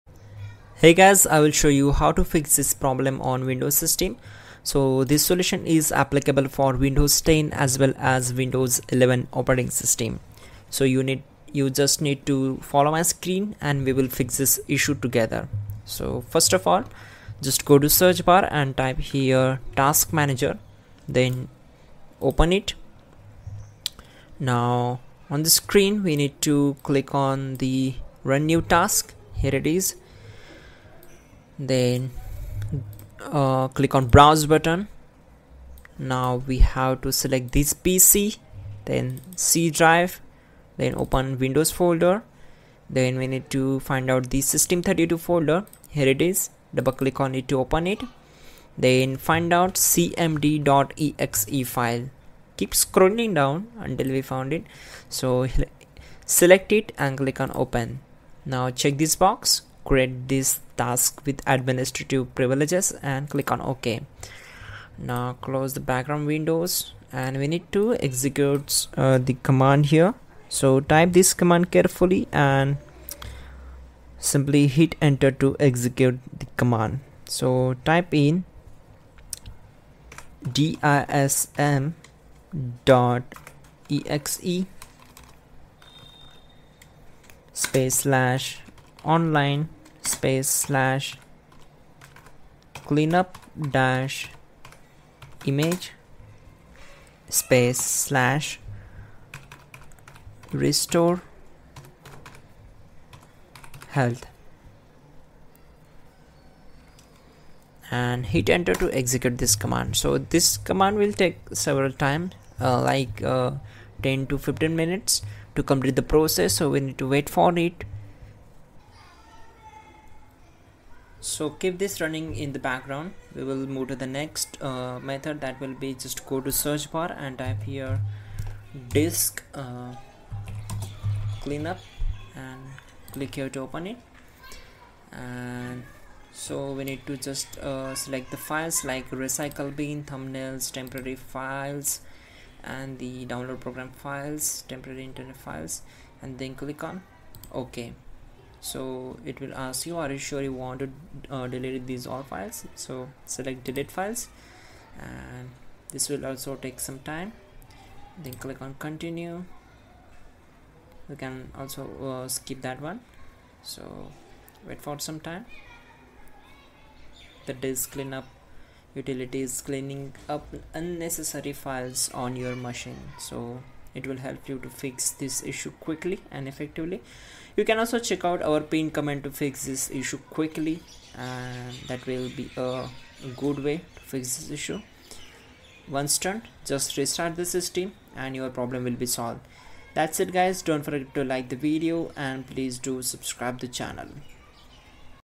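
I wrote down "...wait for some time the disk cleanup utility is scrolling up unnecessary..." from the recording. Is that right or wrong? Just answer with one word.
wrong.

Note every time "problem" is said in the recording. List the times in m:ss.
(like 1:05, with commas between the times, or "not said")
0:02, 3:08.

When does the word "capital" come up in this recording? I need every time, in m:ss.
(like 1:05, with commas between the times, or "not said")
not said.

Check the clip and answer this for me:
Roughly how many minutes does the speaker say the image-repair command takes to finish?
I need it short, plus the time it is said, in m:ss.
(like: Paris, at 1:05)
10 to 15 minutes, at 1:54.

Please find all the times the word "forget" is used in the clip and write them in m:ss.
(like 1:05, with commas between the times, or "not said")
3:10.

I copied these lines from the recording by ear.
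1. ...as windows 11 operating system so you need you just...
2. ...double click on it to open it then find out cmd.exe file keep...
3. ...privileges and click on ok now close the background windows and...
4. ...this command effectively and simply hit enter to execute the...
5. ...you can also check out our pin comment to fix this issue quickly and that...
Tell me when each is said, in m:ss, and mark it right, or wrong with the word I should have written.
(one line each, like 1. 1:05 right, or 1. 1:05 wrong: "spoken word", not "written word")
1. 0:08 right
2. 0:46 right
3. 1:02 right
4. 1:11 wrong: "carefully", not "effectively"
5. 2:57 right.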